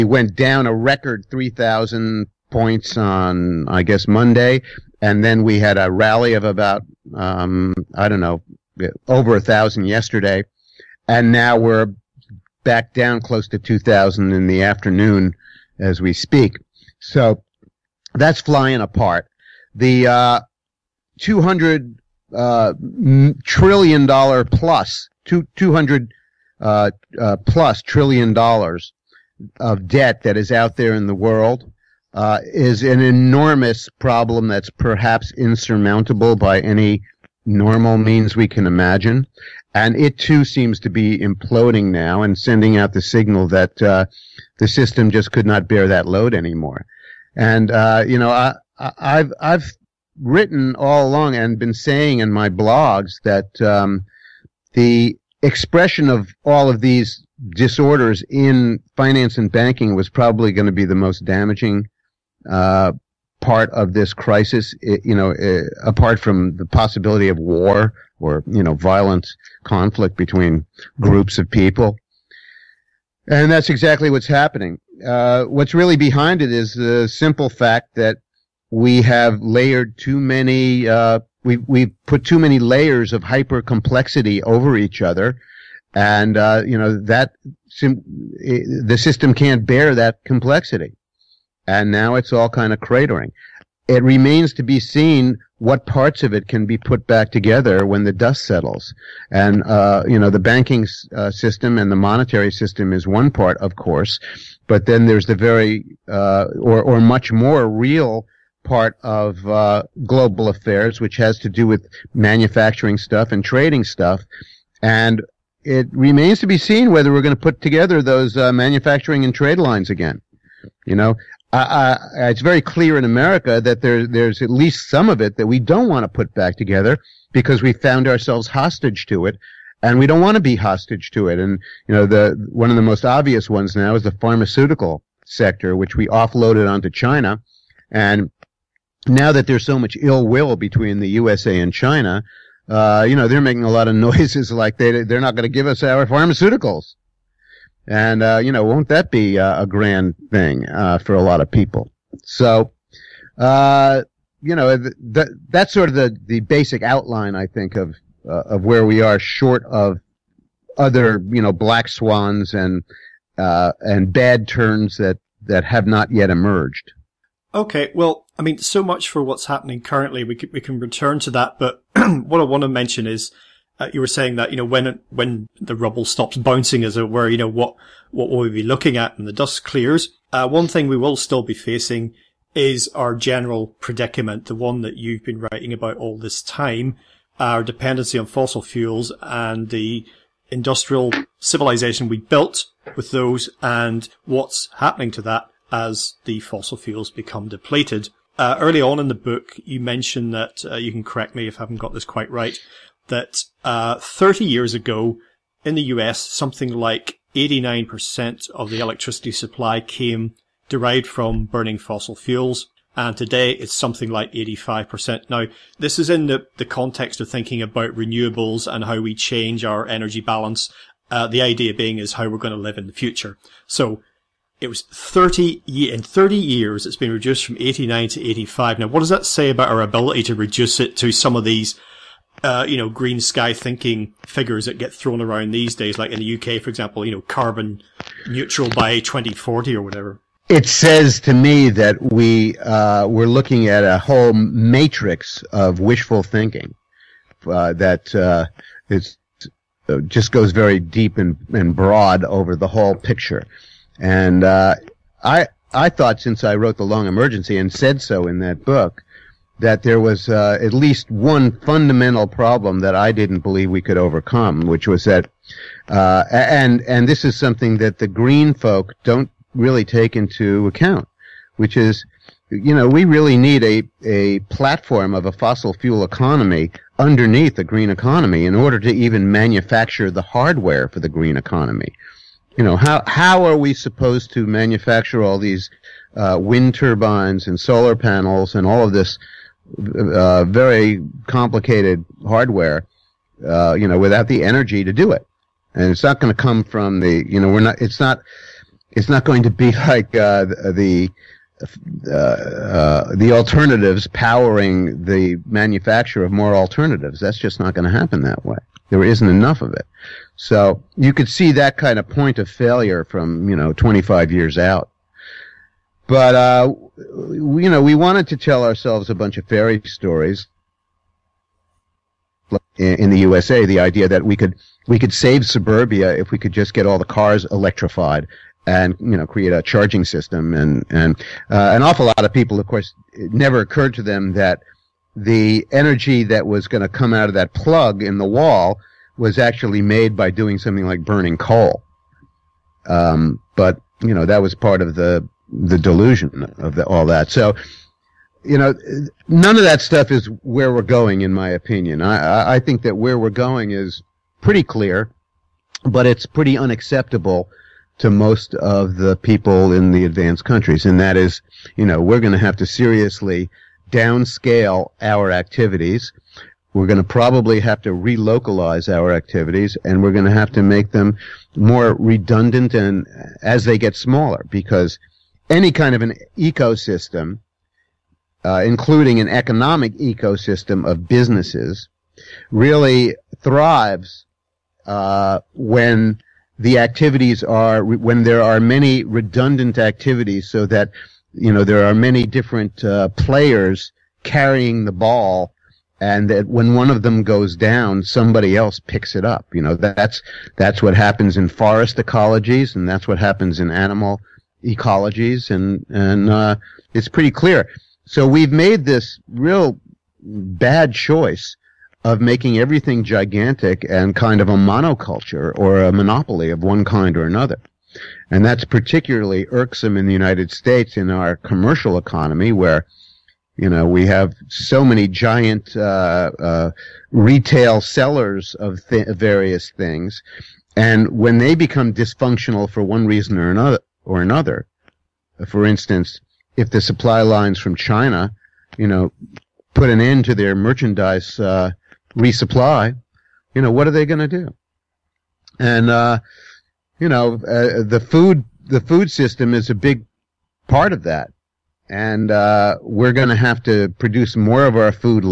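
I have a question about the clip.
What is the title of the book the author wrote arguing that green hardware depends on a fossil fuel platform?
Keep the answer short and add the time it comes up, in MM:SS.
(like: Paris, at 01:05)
The Long Emergency, at 04:16.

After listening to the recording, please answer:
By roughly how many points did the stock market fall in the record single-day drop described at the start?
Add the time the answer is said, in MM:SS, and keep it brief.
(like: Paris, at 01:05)
3,000, at 00:01.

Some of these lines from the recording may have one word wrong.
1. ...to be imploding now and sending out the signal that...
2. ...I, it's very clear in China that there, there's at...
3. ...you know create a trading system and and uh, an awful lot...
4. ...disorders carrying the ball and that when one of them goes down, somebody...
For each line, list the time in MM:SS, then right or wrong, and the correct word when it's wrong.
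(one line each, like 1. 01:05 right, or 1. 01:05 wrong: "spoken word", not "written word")
1. 00:40 right
2. 02:02 wrong: "America", not "China"
3. 05:28 wrong: "charging", not "trading"
4. 06:33 wrong: "players", not "disorders".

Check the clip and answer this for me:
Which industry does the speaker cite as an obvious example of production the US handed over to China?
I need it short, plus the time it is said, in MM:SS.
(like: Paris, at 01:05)
Pharmaceuticals, at 02:14.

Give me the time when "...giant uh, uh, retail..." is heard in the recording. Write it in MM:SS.
07:05.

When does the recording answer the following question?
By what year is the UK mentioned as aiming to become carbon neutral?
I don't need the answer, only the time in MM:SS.
03:58.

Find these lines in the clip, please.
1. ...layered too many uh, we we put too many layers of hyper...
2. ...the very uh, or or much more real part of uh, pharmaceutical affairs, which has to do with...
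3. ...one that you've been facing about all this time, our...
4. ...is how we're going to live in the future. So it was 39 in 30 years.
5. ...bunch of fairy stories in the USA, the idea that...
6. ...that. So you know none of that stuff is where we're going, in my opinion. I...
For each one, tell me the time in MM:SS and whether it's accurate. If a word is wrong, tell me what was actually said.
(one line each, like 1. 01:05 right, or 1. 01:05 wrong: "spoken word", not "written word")
1. 01:19 right
2. 01:45 wrong: "global", not "pharmaceutical"
3. 03:04 wrong: "writing", not "facing"
4. 03:41 wrong: "30", not "39"
5. 05:19 right
6. 05:47 right.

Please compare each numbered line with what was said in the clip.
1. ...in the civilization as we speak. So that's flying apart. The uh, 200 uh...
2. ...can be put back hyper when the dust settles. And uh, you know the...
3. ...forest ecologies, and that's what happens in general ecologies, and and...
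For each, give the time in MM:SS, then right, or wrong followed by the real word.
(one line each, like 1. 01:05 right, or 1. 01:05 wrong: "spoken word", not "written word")
1. 00:14 wrong: "afternoon", not "civilization"
2. 01:36 wrong: "together", not "hyper"
3. 06:41 wrong: "animal", not "general".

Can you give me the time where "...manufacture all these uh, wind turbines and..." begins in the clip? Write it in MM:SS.
04:44.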